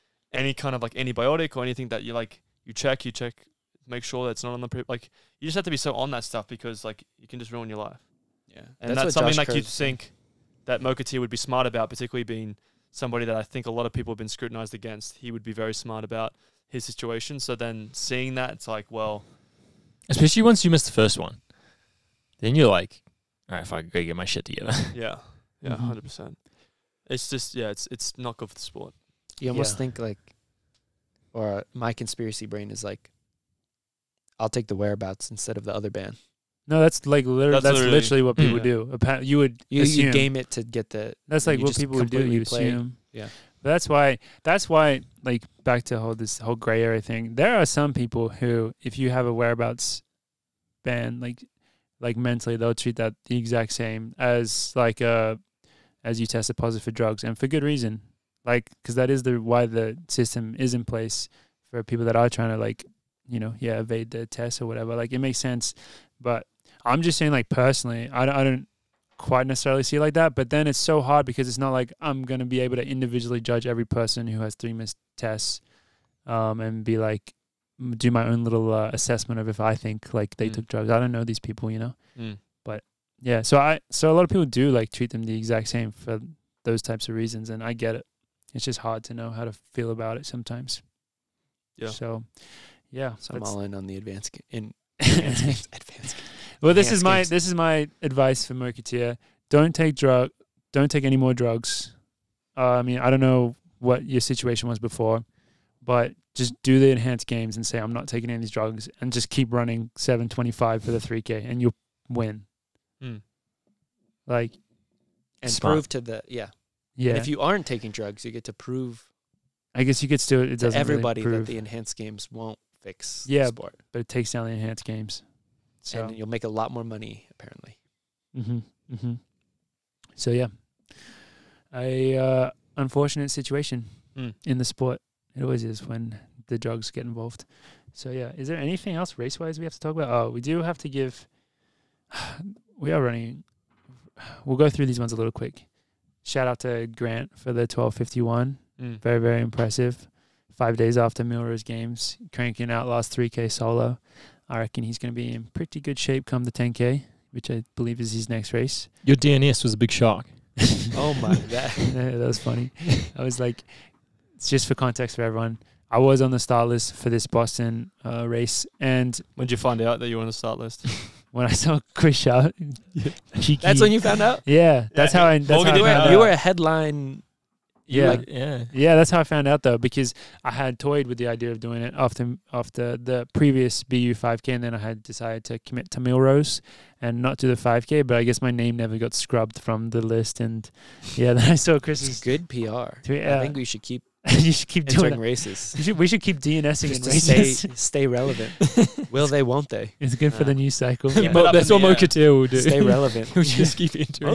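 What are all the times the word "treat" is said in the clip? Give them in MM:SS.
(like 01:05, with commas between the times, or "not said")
00:52, 01:24.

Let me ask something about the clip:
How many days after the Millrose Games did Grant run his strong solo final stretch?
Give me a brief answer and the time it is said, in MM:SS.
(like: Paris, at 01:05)
5, at 02:30.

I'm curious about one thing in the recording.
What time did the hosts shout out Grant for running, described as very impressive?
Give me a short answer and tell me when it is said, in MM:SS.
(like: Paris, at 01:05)
12:51, at 02:27.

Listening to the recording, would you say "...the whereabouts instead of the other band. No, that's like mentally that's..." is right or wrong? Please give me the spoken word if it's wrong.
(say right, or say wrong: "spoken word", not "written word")
wrong: "literally", not "mentally".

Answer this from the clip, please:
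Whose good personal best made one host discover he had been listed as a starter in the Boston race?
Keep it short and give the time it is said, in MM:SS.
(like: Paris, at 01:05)
Chris Shaw, at 02:51.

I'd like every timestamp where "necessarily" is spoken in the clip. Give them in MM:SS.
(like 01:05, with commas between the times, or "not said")
01:09.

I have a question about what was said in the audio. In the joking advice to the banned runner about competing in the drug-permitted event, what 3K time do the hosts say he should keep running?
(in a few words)
7:25.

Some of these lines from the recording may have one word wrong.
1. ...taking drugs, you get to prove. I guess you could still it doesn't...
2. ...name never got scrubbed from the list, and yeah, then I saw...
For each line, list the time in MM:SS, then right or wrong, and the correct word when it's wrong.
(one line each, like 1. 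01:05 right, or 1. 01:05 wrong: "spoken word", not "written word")
1. 01:57 right
2. 03:08 right.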